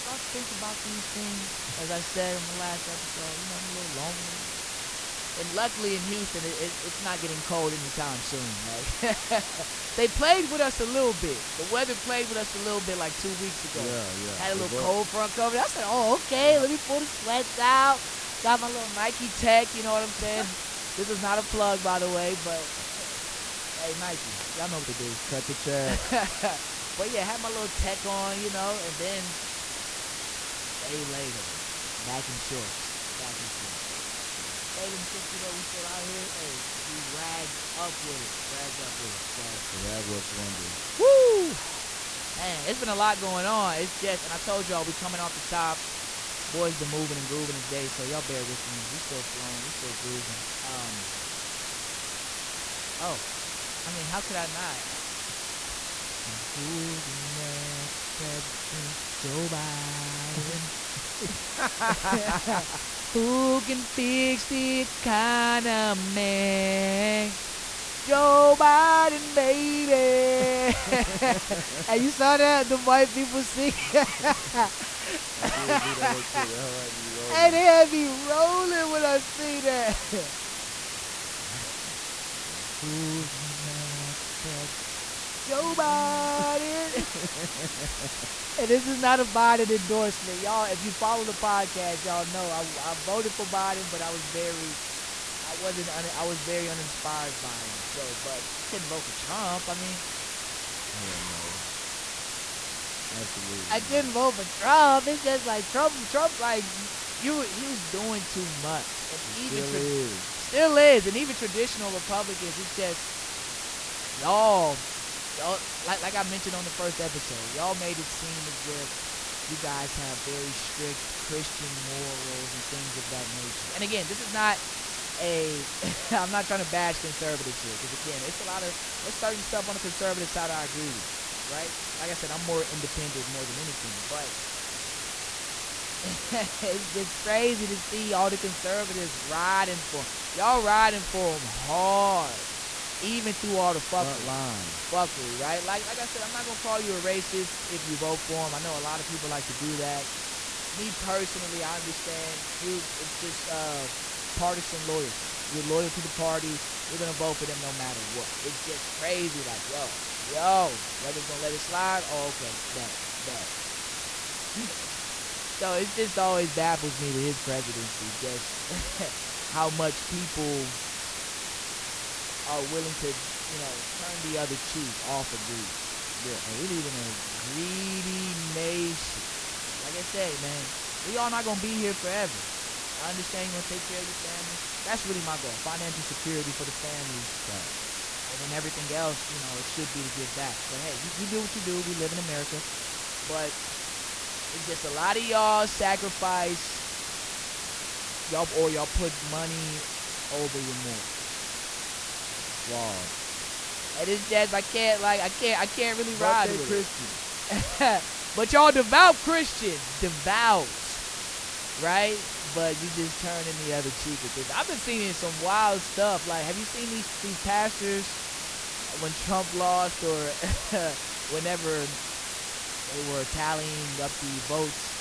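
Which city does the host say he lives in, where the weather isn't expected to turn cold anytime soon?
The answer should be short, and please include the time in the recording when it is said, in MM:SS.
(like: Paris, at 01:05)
Houston, at 00:06.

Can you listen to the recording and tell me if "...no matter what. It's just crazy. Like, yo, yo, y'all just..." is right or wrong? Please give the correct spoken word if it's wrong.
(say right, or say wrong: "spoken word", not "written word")
right.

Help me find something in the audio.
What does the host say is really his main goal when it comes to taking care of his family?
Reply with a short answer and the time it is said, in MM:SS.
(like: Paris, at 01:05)
Financial security, at 03:05.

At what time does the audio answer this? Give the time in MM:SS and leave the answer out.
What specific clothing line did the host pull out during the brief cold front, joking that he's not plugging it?
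00:18.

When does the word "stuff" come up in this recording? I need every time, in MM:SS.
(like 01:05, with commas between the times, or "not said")
02:09, 03:35.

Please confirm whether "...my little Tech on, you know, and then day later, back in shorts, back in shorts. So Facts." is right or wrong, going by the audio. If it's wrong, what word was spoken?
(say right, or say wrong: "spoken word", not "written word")
right.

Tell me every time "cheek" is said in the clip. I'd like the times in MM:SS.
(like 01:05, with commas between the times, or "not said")
02:54, 03:33.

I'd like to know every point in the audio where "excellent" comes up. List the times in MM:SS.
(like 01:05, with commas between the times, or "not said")
not said.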